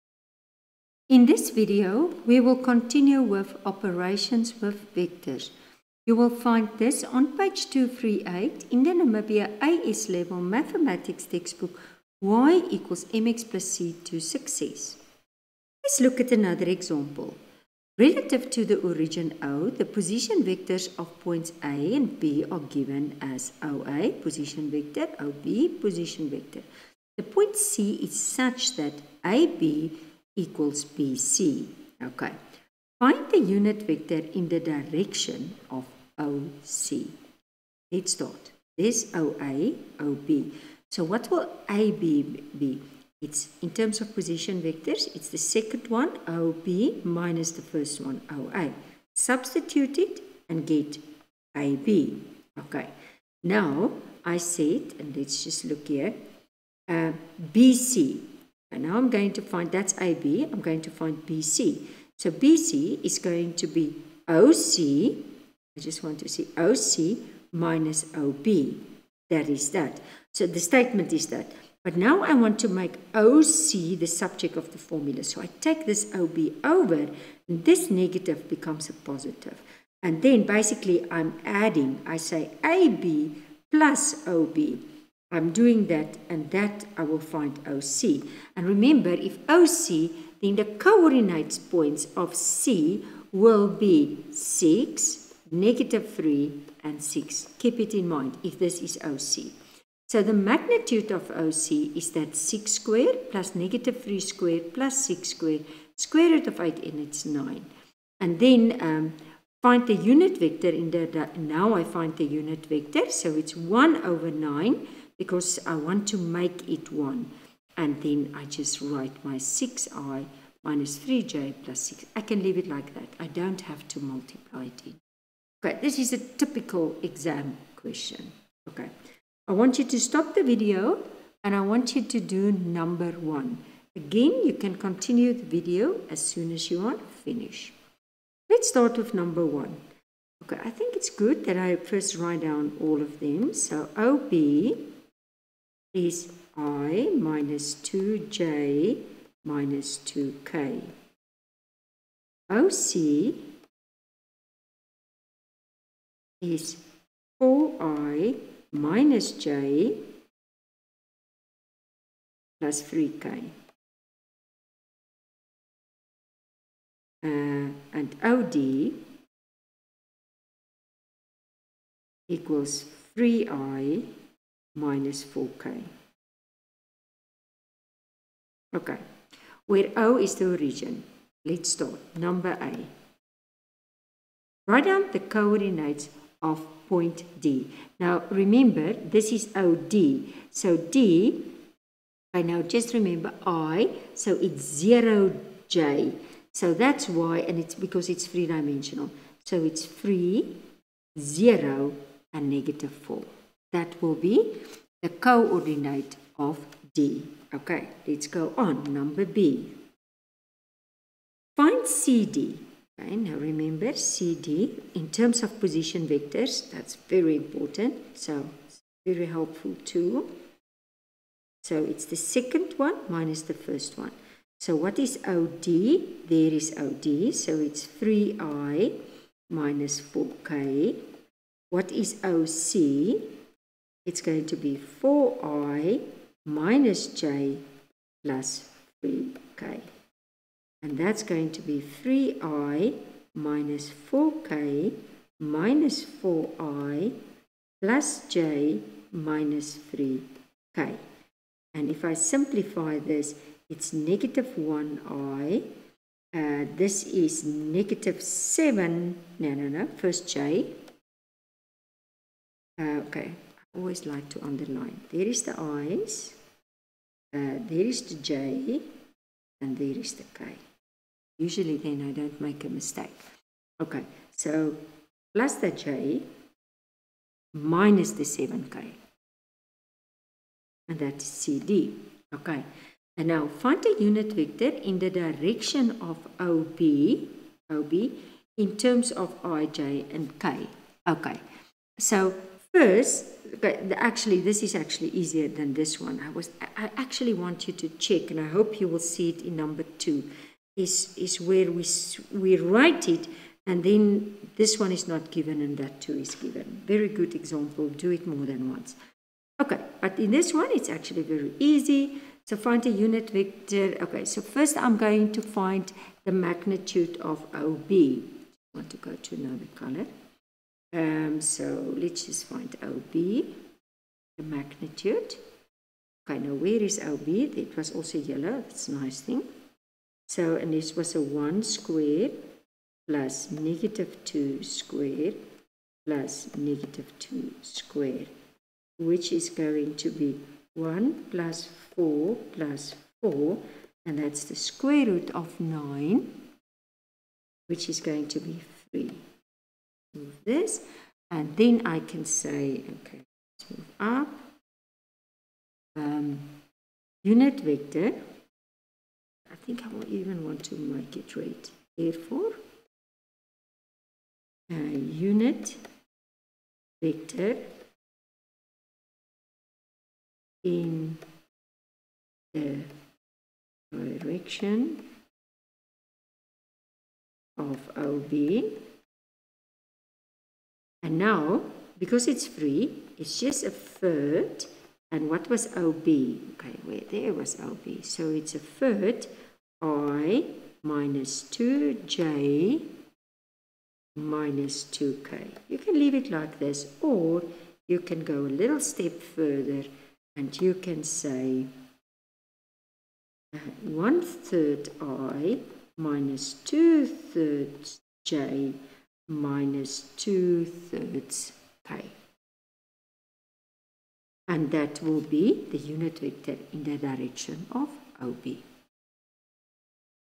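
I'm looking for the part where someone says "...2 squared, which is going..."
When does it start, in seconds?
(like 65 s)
337 s.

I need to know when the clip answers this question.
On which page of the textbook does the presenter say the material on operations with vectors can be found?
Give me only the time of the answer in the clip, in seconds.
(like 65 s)
7 s.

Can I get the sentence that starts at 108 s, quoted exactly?
And then um, find the unit vector in the, now I find the unit vector.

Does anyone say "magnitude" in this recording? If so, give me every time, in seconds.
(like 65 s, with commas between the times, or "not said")
100 s, 316 s, 324 s.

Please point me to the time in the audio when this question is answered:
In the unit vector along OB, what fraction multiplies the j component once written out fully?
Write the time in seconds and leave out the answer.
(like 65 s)
405 s.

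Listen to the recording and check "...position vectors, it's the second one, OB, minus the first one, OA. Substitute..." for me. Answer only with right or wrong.
right.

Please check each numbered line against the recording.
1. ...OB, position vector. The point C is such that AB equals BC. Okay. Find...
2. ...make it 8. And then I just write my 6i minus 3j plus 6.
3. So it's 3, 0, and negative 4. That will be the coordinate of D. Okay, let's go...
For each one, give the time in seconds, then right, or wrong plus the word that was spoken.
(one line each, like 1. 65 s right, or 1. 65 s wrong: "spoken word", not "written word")
1. 25 s right
2. 116 s wrong: "1", not "8"
3. 199 s right.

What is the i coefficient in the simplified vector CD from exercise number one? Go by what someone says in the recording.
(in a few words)
-1.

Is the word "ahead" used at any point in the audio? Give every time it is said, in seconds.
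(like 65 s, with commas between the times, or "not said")
not said.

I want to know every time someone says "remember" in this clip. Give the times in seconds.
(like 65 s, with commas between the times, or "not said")
88 s, 188 s, 192 s, 213 s.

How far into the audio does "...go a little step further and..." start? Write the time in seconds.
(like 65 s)
398 s.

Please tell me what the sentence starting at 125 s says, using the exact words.
Okay, this is a typical exam question.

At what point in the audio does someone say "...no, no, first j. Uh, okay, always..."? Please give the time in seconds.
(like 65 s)
259 s.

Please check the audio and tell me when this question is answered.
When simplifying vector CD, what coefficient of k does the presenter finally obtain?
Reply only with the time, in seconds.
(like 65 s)
277 s.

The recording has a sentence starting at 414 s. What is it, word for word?
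And that will be the unit vector in the direction of OB.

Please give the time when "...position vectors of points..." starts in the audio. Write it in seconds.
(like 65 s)
19 s.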